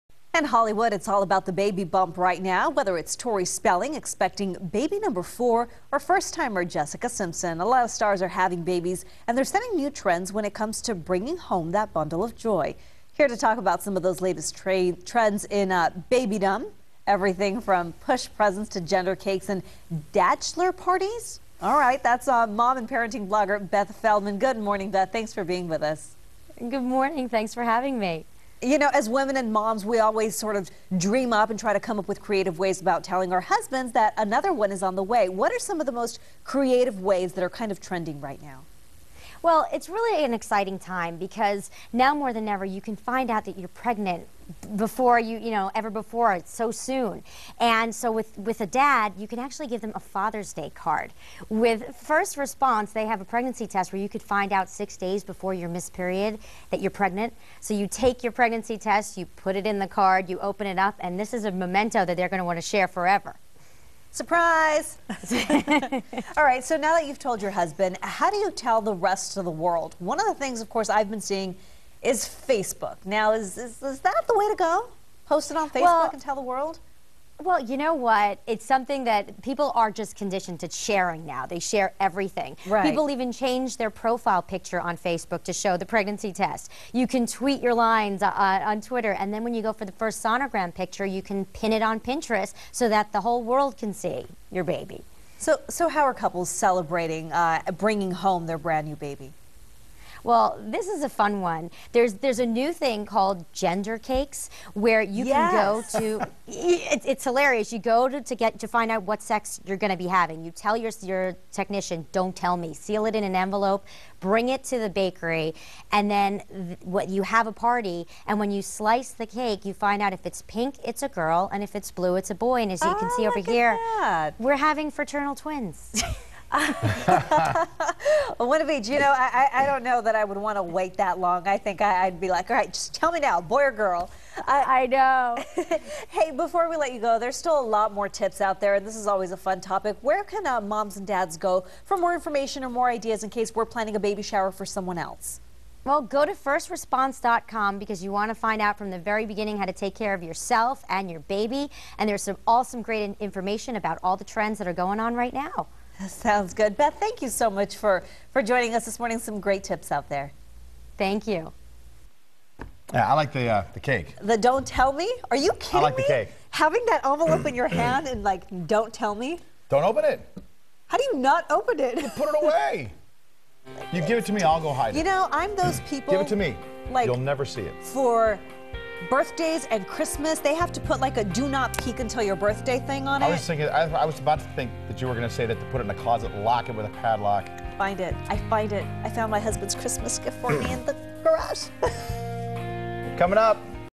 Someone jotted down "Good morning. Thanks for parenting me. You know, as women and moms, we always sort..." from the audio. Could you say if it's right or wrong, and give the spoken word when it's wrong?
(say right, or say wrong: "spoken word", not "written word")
wrong: "having", not "parenting".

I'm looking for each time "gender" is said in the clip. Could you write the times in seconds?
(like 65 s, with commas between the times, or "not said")
18 s, 103 s.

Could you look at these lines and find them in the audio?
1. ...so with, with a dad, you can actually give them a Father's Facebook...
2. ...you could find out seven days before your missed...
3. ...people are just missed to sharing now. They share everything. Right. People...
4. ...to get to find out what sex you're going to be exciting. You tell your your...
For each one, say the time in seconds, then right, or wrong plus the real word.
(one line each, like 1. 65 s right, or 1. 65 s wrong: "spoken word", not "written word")
1. 47 s wrong: "Day", not "Facebook"
2. 54 s wrong: "six", not "seven"
3. 79 s wrong: "conditioned", not "missed"
4. 108 s wrong: "having", not "exciting".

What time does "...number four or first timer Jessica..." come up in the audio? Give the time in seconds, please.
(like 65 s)
4 s.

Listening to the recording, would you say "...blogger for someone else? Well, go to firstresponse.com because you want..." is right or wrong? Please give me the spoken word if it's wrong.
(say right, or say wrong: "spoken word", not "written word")
wrong: "shower", not "blogger".